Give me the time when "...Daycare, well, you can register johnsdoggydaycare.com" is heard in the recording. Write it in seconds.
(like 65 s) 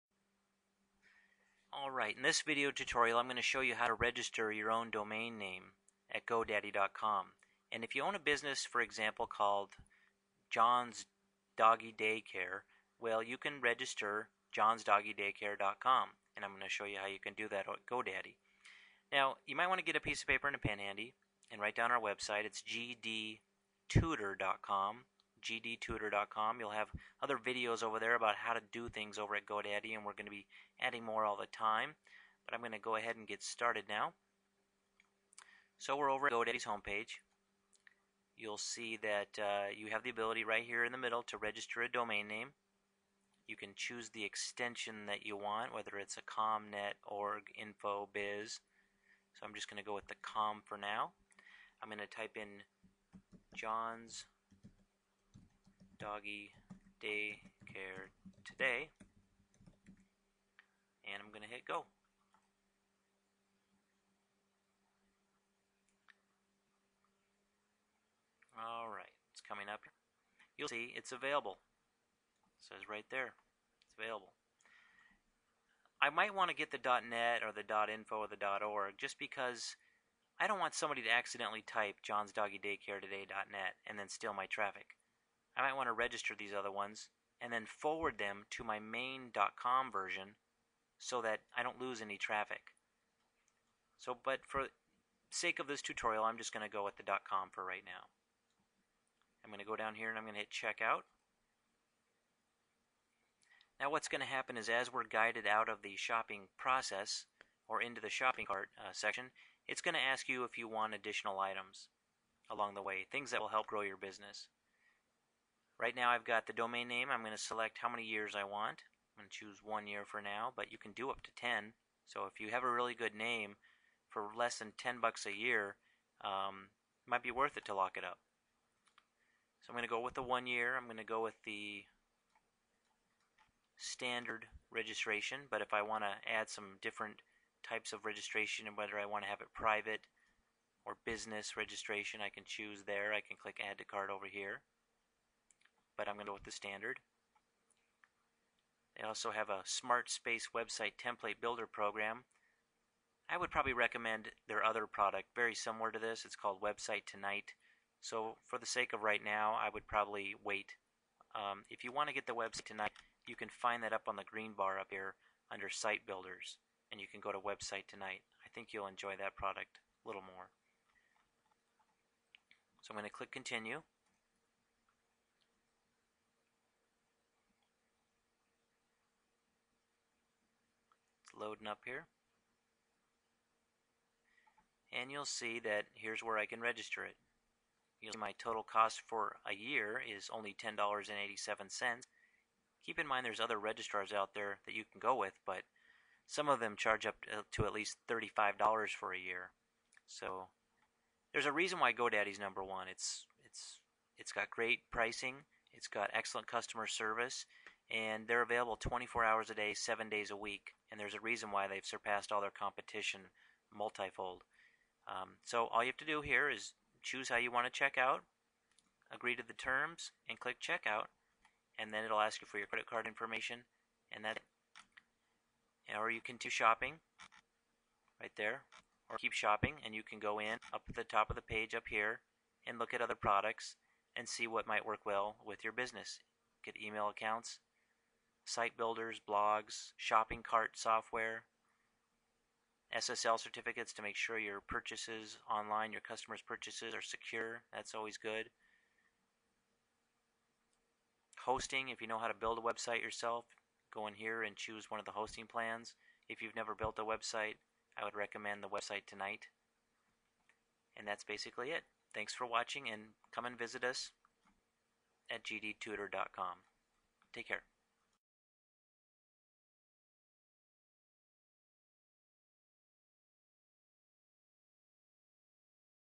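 11 s.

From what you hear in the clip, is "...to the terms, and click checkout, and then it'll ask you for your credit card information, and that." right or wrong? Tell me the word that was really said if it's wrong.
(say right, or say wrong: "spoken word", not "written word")
right.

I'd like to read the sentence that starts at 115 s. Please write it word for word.
Right now I've got the domain name.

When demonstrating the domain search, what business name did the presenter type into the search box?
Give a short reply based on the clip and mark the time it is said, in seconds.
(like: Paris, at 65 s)
John's doggy daycare today, at 53 s.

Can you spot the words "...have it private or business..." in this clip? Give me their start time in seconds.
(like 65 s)
139 s.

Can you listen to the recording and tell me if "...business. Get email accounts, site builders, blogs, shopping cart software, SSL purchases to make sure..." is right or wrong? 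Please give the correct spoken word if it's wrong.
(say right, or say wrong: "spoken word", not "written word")
wrong: "certificates", not "purchases".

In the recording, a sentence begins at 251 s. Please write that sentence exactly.
Hosting, if you know how to build a website yourself, go in here and choose one of the hosting plans.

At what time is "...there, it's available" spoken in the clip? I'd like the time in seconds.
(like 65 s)
73 s.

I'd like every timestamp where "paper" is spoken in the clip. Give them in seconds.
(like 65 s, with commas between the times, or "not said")
20 s.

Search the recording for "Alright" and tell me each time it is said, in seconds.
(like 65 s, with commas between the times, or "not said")
1 s, 68 s.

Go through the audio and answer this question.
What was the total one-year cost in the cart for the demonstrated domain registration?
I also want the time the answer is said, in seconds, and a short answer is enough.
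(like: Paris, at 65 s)
$10.87, at 190 s.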